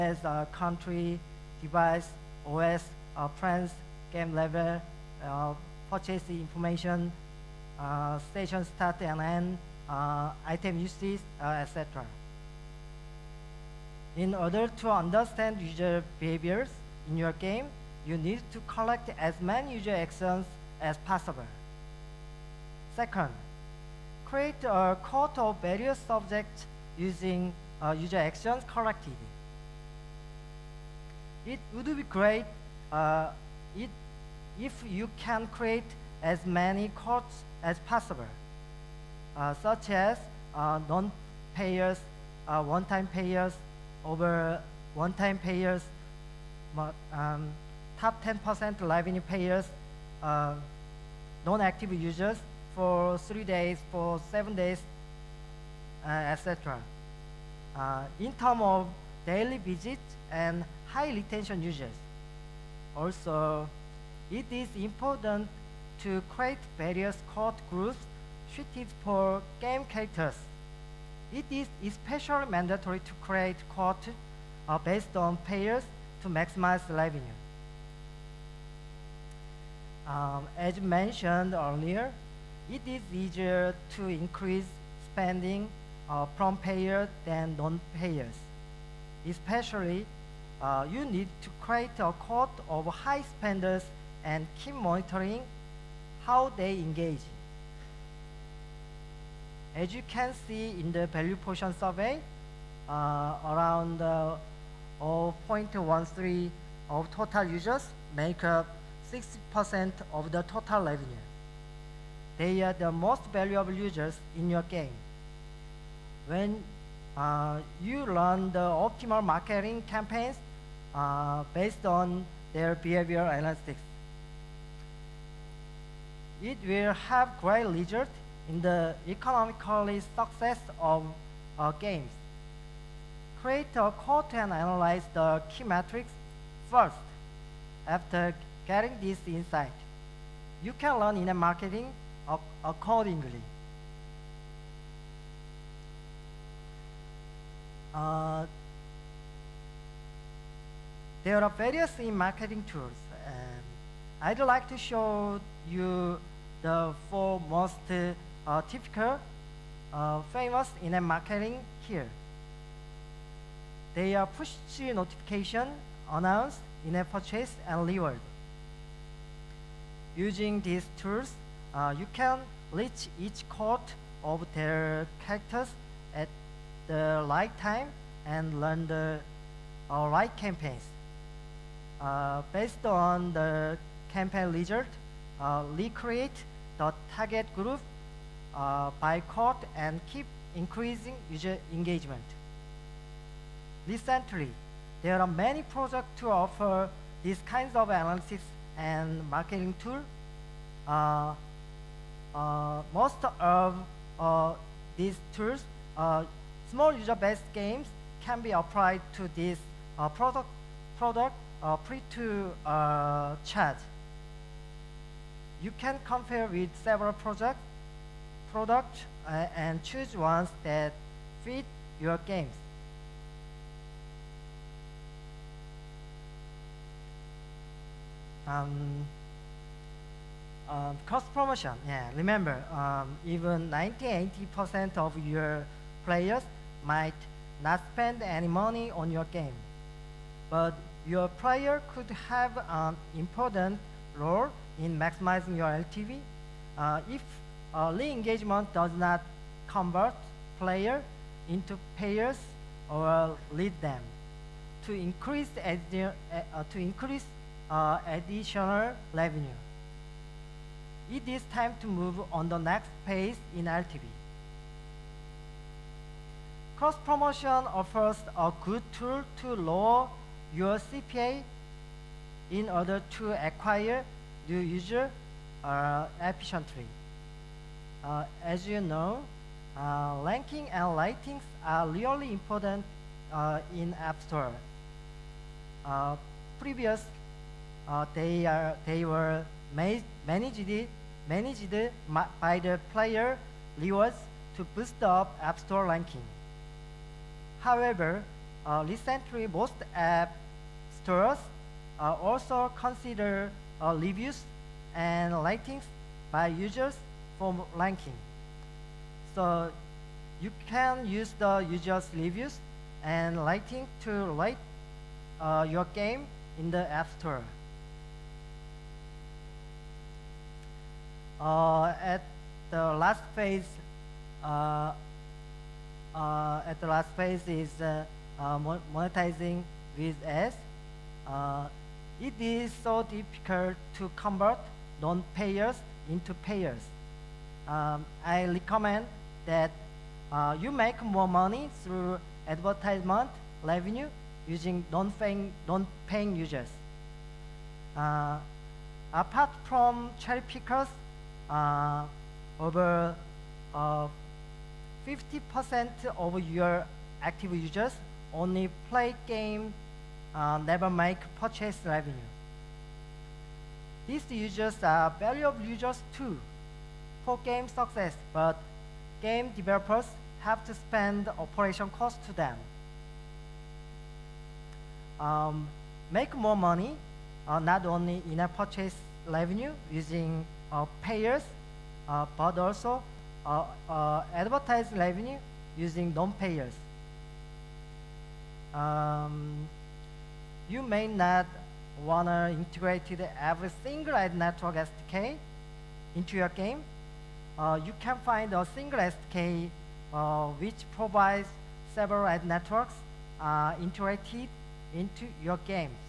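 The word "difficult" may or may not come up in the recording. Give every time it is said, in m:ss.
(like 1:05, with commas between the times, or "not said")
5:33.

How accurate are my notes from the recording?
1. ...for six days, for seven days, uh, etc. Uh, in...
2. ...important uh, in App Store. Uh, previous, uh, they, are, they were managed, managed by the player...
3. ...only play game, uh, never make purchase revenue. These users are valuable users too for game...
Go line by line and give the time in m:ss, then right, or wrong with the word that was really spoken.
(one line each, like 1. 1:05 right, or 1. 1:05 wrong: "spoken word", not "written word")
1. 0:52 wrong: "three", not "six"
2. 4:42 right
3. 5:58 right.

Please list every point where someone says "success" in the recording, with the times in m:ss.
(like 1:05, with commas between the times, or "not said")
2:10, 6:07.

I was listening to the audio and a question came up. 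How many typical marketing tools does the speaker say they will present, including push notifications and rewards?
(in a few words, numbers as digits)
4.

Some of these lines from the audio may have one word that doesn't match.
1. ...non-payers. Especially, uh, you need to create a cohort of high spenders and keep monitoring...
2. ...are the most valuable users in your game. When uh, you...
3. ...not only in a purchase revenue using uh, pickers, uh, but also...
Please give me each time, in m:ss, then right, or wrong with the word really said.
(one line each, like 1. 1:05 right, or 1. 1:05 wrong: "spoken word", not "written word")
1. 1:27 right
2. 1:52 right
3. 6:17 wrong: "payers", not "pickers".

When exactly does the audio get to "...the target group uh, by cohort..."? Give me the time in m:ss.
3:06.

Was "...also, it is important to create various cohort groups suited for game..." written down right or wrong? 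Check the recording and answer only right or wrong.
right.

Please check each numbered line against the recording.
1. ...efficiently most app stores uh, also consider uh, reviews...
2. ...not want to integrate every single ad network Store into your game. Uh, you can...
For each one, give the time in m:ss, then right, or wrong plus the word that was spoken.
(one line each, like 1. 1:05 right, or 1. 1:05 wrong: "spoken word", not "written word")
1. 4:58 wrong: "recently", not "efficiently"
2. 6:31 wrong: "SDK", not "Store".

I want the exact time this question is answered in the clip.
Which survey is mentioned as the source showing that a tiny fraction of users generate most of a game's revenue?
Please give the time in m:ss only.
1:41.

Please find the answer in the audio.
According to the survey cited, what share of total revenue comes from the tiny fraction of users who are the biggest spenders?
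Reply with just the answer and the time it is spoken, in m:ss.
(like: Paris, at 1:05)
60%, at 1:49.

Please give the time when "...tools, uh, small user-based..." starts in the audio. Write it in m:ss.
3:25.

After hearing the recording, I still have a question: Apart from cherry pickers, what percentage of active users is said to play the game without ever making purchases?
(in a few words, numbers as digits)
Over 50%.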